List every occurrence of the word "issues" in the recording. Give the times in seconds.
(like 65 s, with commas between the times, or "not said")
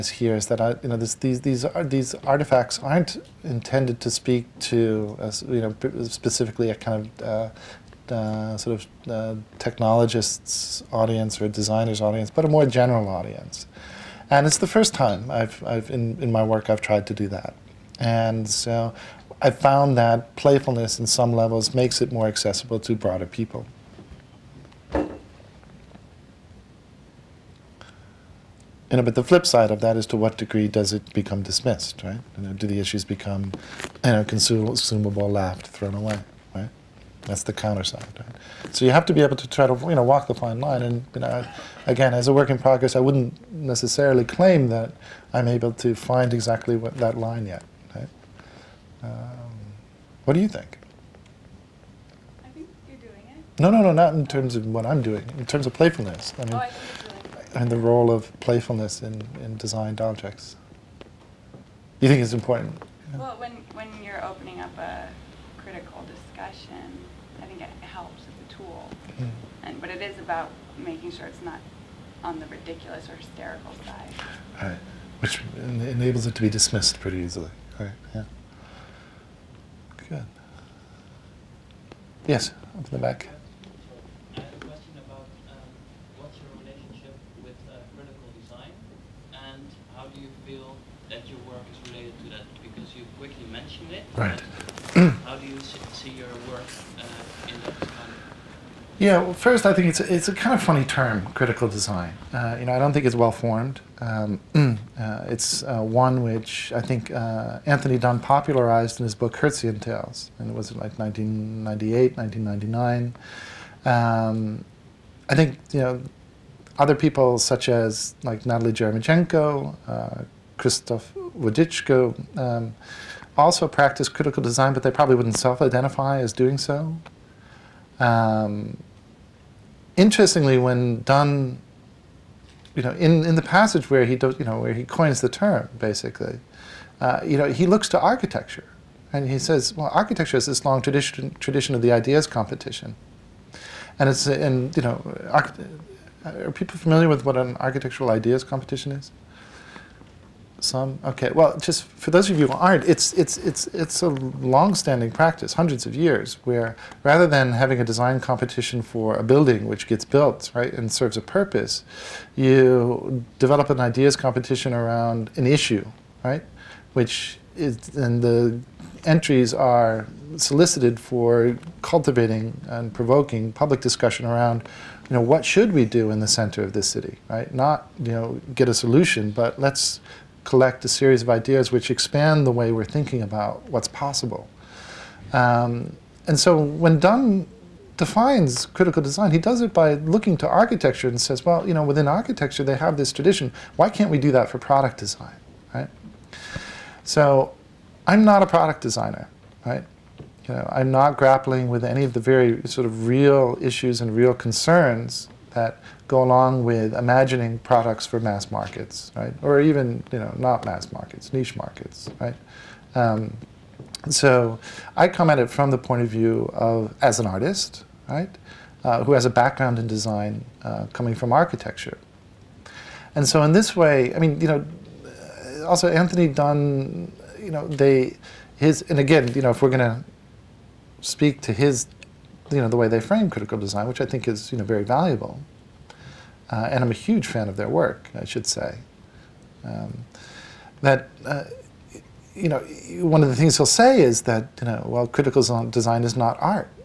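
32 s, 165 s, 203 s.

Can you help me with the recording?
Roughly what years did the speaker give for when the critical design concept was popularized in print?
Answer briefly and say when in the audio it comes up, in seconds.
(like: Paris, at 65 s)
1998, 1999, at 110 s.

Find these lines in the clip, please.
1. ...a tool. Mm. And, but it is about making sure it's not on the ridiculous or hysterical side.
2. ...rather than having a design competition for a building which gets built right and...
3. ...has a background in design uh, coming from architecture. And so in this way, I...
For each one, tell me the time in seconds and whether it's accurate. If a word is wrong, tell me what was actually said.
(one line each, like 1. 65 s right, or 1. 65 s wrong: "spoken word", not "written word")
1. 68 s right
2. 157 s right
3. 219 s right.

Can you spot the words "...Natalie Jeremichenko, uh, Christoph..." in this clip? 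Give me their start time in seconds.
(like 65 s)
118 s.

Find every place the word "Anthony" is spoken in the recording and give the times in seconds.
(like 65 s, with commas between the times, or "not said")
107 s, 225 s.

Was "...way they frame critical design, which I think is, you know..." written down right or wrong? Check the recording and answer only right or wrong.
right.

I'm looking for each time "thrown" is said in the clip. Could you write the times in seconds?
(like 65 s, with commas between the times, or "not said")
35 s.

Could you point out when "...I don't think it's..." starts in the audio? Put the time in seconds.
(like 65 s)
102 s.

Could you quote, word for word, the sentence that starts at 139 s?
And he says, well, architecture is this long tradition, tradition of the ideas competition.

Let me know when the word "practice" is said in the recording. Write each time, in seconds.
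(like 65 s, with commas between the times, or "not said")
123 s, 155 s.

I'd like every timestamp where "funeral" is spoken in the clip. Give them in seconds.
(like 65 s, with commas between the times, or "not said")
not said.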